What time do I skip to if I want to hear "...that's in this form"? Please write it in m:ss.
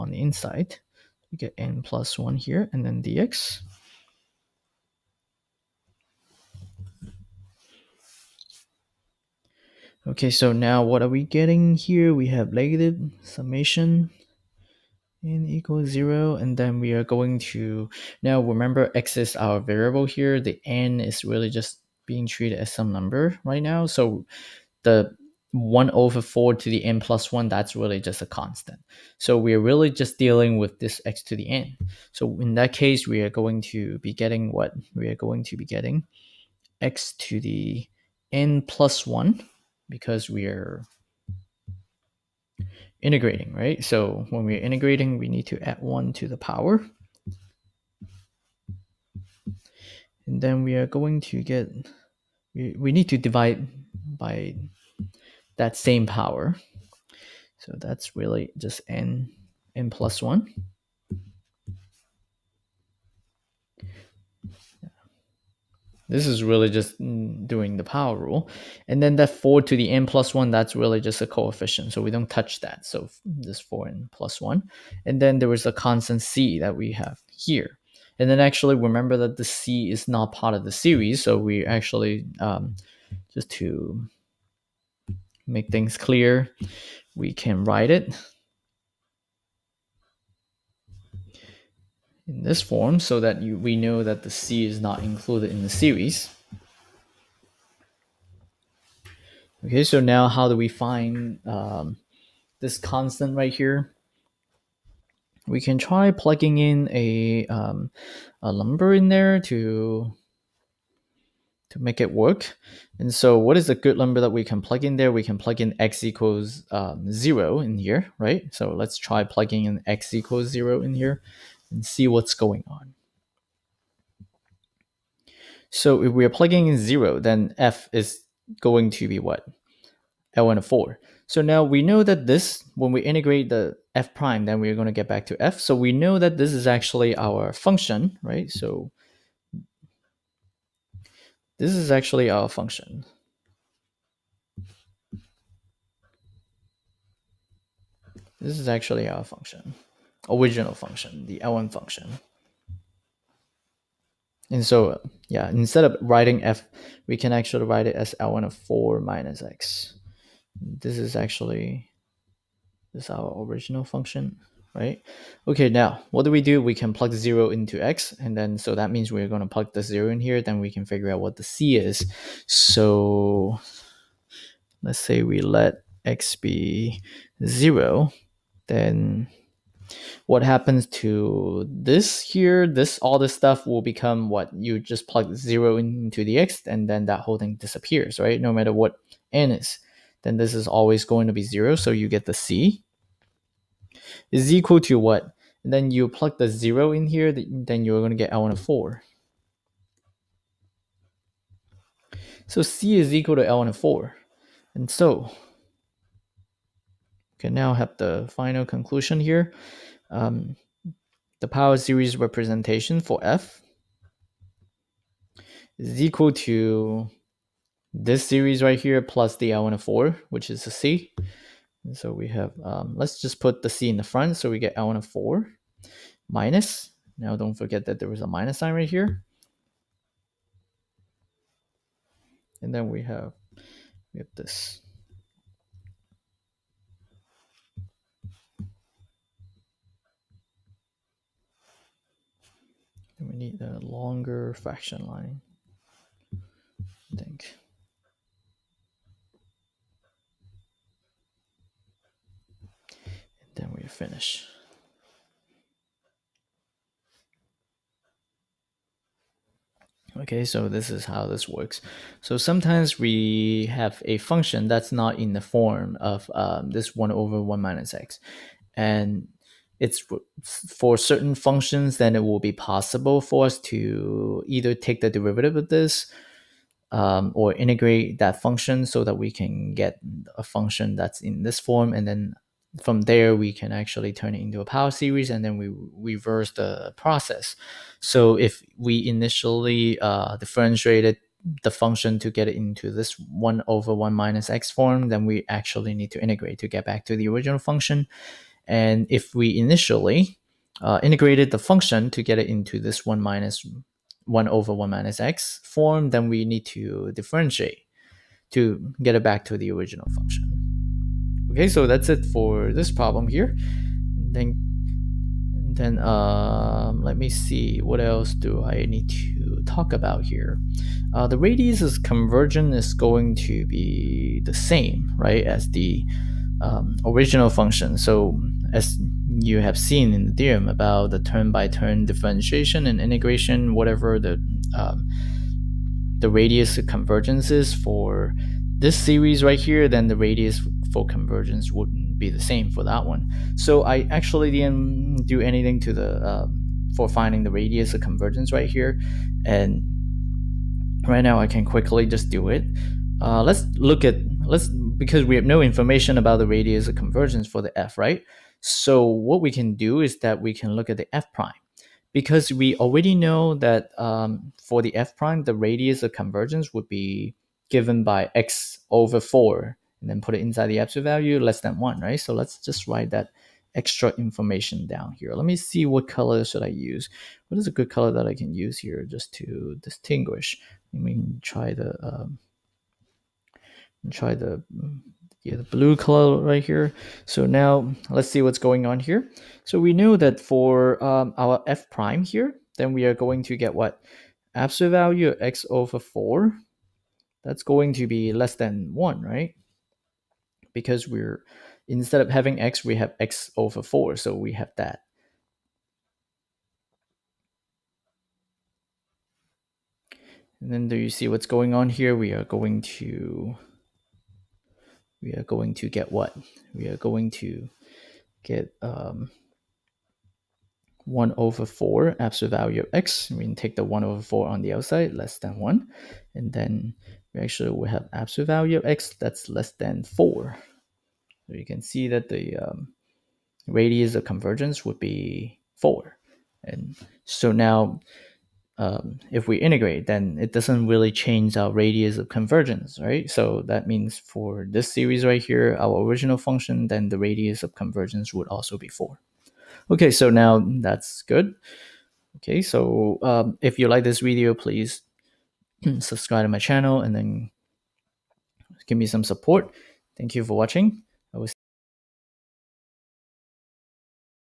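4:40.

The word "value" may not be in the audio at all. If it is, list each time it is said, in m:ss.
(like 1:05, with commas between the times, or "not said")
6:11, 6:34, 7:02, 7:08.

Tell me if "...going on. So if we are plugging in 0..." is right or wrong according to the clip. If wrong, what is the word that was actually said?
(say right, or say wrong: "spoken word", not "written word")
right.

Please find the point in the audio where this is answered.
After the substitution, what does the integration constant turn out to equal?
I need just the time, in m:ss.
3:22.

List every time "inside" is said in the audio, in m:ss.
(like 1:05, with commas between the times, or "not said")
0:00, 6:10.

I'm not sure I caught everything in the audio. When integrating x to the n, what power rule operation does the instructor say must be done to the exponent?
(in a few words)
Add 1.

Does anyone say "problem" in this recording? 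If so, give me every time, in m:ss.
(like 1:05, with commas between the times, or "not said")
5:12.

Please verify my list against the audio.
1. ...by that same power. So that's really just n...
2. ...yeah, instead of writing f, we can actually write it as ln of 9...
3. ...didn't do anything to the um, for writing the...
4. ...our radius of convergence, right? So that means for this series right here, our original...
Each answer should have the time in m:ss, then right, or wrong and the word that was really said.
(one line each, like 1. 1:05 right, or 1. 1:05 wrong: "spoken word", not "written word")
1. 0:54 right
2. 2:35 wrong: "4", not "9"
3. 5:44 wrong: "finding", not "writing"
4. 7:21 right.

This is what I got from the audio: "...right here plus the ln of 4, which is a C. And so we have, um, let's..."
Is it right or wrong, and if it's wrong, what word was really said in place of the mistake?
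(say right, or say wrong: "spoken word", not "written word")
right.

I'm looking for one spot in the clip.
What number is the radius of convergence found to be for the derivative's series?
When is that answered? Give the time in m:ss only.
7:13.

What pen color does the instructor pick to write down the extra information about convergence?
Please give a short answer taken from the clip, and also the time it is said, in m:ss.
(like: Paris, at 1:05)
Blue, at 6:25.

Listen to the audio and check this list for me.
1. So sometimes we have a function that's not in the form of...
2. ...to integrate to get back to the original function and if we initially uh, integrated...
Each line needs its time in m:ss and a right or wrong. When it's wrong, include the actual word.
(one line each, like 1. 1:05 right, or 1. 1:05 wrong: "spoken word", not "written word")
1. 4:22 right
2. 4:56 right.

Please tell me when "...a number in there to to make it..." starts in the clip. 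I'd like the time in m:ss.
1:48.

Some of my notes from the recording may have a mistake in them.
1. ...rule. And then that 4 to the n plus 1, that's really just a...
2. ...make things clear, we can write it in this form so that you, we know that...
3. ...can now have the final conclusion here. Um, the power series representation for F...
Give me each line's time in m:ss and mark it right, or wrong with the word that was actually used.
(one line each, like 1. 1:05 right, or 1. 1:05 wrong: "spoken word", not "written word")
1. 1:08 right
2. 1:25 right
3. 3:27 right.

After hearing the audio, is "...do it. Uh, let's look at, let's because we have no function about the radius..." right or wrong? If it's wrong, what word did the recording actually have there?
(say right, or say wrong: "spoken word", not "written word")
wrong: "information", not "function".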